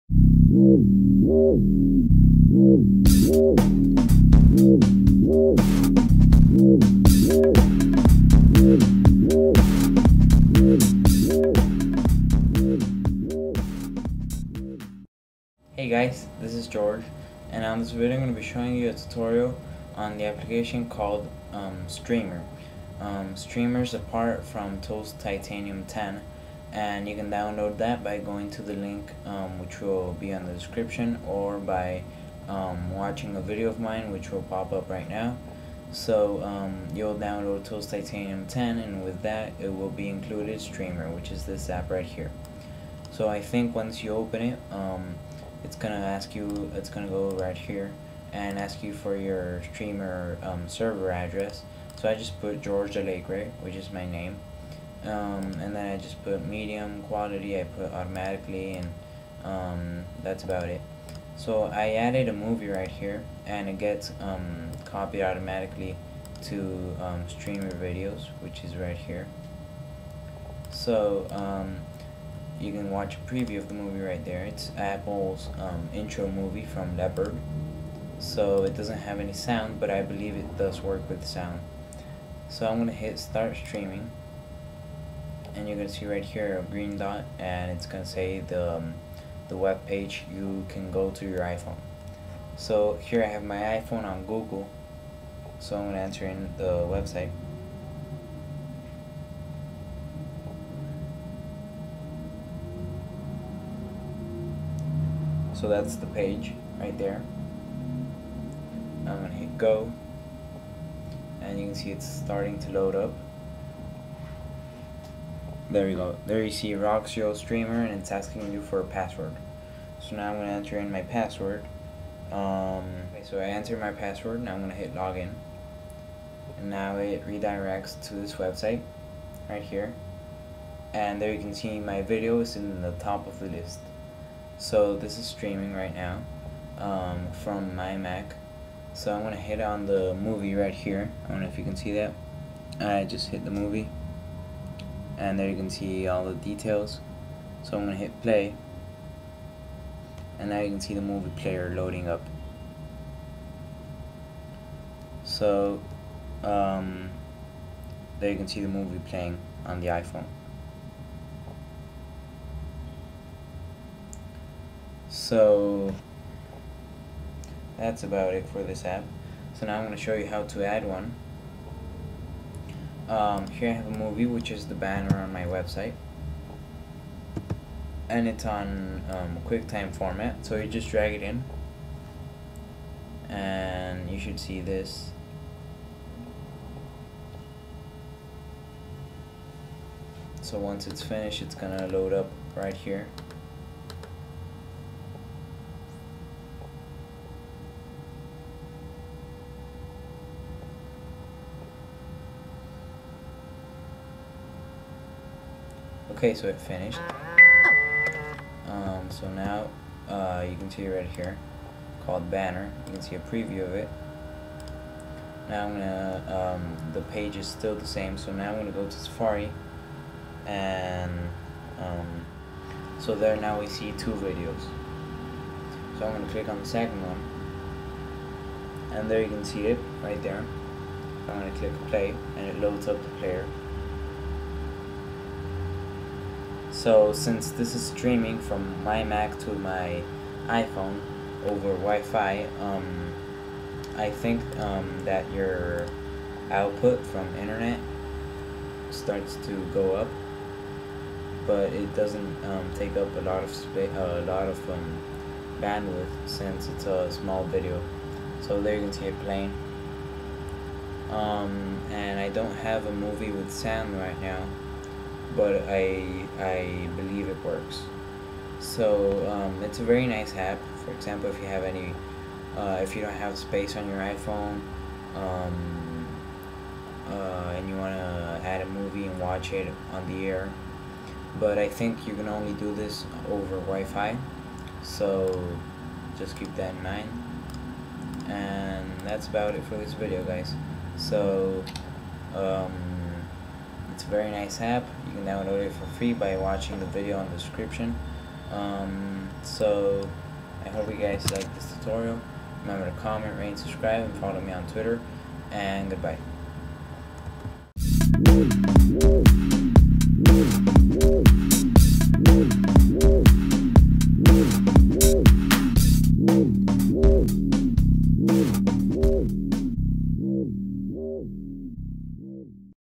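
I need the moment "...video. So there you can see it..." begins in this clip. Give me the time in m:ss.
4:17.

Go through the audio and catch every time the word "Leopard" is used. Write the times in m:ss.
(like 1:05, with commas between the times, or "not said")
1:16.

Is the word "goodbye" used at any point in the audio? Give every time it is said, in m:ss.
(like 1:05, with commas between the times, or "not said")
5:05.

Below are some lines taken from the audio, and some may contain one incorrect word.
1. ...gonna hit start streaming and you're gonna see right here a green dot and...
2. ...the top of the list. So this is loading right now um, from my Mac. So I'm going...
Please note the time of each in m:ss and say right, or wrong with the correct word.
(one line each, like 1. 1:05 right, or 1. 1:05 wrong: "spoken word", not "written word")
1. 1:22 right
2. 2:12 wrong: "streaming", not "loading".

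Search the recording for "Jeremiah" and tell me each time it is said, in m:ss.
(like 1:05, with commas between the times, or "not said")
not said.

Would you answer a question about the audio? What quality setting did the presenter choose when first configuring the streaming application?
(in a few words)
Medium quality.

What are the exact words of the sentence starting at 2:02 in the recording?
Um, okay, so I enter my password and I'm going to hit login.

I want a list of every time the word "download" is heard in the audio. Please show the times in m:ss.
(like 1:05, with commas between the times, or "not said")
0:27, 0:37, 4:55.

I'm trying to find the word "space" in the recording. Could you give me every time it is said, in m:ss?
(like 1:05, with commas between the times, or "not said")
4:13, 4:33.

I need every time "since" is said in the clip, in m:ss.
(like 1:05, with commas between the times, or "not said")
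3:57, 4:16.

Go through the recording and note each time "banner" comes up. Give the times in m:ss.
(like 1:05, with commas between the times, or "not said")
2:54, 3:32.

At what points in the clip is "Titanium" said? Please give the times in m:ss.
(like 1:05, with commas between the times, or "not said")
0:25, 0:37.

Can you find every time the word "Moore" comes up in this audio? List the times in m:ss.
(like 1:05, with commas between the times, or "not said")
not said.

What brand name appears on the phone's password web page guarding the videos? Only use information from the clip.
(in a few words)
Roxio.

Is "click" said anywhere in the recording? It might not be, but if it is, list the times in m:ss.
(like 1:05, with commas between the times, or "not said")
3:46, 3:51.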